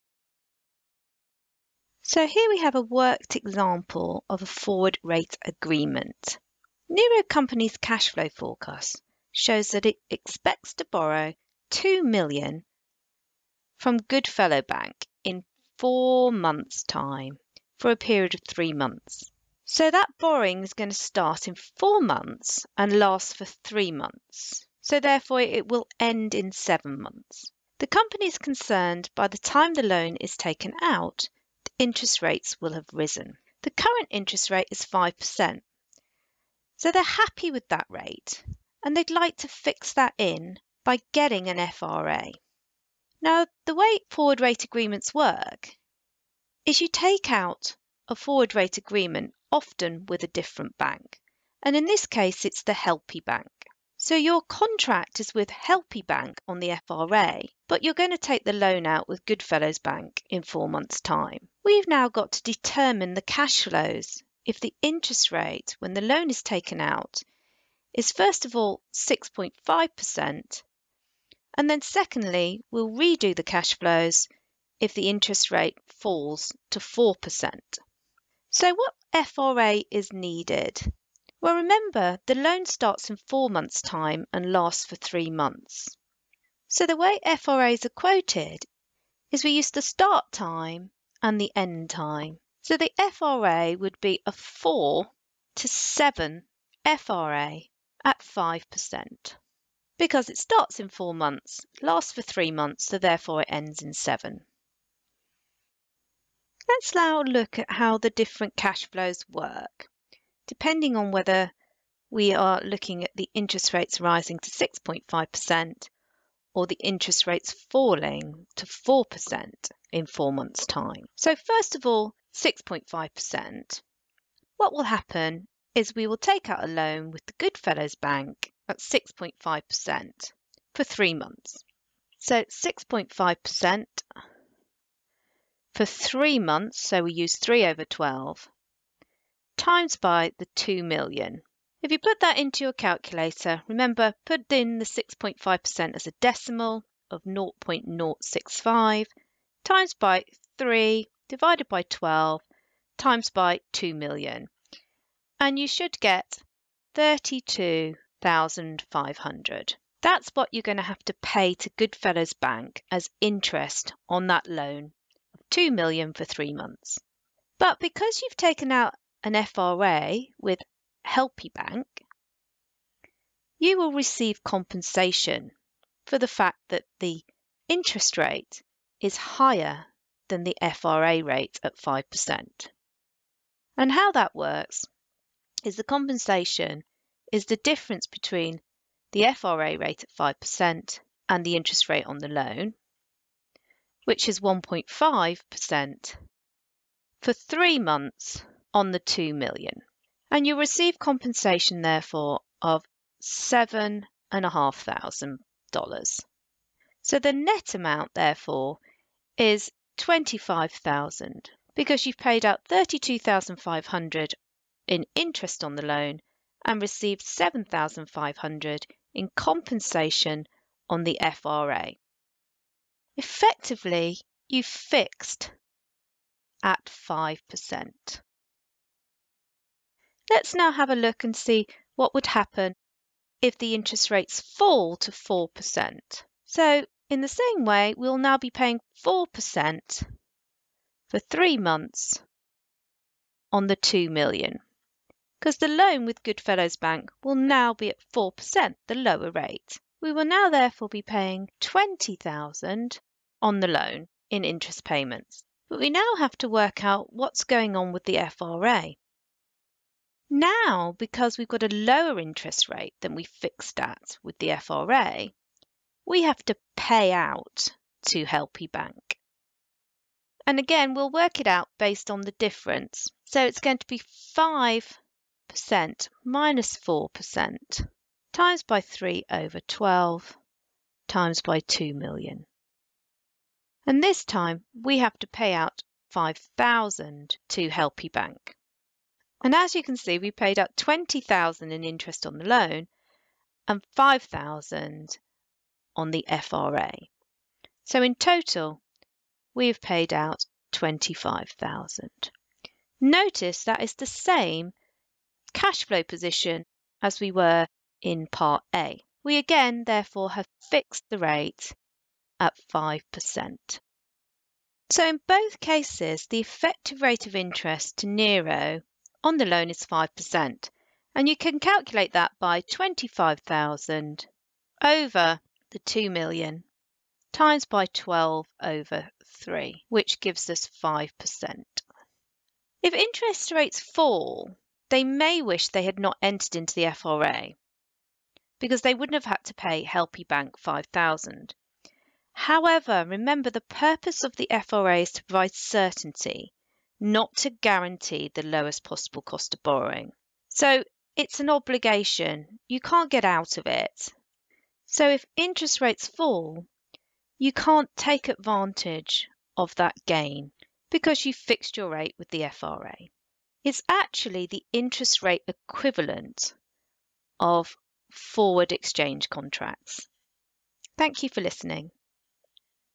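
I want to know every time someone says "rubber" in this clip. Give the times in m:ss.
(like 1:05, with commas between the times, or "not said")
not said.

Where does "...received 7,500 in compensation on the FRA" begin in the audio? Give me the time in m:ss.
3:36.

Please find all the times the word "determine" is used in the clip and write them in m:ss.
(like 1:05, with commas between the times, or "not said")
1:02.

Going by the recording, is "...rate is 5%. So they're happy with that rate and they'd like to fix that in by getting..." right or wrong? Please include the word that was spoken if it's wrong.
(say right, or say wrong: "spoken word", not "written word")
right.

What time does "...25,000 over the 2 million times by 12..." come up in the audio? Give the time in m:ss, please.
5:22.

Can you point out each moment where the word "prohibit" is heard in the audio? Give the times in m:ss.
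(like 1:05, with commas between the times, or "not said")
not said.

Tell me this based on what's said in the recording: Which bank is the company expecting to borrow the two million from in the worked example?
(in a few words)
Goodfellow Bank.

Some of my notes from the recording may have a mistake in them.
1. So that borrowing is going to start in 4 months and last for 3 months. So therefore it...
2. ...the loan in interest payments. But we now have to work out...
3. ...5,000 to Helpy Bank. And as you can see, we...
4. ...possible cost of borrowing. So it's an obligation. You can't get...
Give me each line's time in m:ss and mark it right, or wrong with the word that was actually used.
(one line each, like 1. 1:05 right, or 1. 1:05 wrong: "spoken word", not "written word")
1. 0:19 right
2. 4:13 right
3. 4:46 right
4. 5:48 right.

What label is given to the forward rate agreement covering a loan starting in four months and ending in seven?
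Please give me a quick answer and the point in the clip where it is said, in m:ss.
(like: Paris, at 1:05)
4 to 7 FRA, at 1:34.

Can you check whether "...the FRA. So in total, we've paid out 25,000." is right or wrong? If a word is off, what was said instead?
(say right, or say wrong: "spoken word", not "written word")
right.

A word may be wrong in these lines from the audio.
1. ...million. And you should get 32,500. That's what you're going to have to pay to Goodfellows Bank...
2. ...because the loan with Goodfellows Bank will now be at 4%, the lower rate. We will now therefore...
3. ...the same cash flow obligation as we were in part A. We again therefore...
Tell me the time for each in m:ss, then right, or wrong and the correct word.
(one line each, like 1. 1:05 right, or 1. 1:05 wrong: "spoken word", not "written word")
1. 2:33 right
2. 4:05 right
3. 5:03 wrong: "position", not "obligation".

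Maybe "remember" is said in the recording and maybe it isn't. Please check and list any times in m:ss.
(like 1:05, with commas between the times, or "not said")
1:21, 2:23, 5:43.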